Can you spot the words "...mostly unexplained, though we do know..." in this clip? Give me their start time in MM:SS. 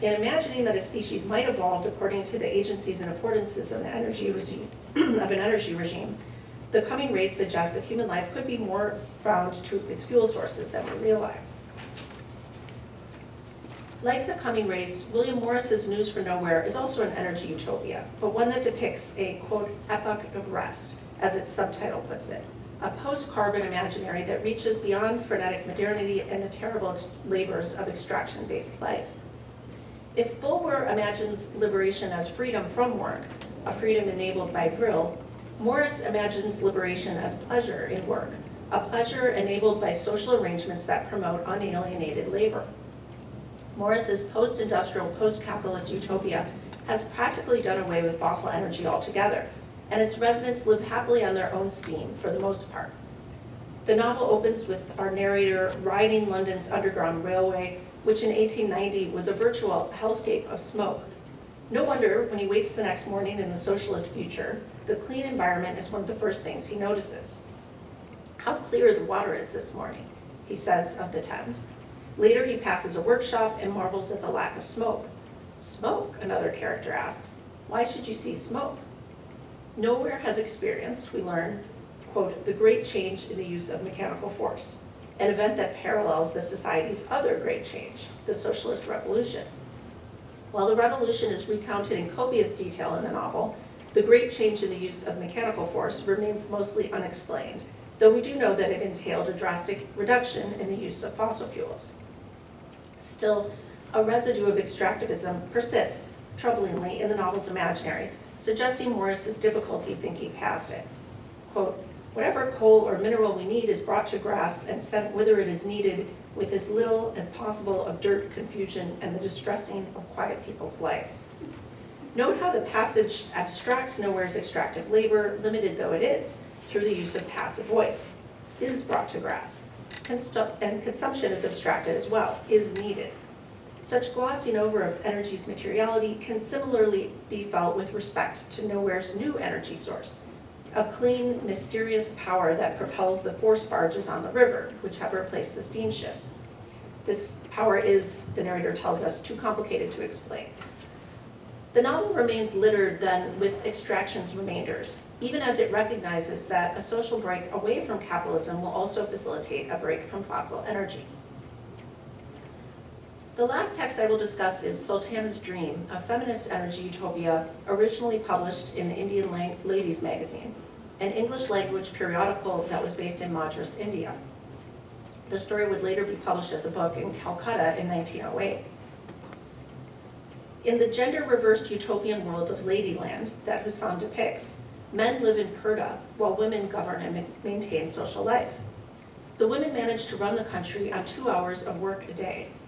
01:36.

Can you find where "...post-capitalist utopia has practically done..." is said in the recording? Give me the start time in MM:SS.
00:45.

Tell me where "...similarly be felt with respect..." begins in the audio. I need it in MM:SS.
02:16.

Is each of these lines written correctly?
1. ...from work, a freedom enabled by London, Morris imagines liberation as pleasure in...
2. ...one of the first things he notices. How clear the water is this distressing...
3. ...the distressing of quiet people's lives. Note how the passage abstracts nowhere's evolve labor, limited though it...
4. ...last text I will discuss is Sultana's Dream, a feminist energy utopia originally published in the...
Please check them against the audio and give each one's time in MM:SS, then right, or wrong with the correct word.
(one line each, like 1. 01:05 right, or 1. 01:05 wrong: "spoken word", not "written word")
1. 00:32 wrong: "Vril", not "London"
2. 01:05 wrong: "morning", not "distressing"
3. 01:59 wrong: "extractive", not "evolve"
4. 02:43 right.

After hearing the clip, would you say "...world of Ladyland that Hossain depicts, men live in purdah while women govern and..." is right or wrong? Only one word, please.
right.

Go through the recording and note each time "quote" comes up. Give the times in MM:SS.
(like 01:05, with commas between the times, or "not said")
00:19, 01:22, 01:51.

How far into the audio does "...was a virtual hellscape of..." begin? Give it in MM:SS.
00:59.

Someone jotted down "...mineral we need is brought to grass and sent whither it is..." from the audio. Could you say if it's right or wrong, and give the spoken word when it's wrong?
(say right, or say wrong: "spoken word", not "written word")
right.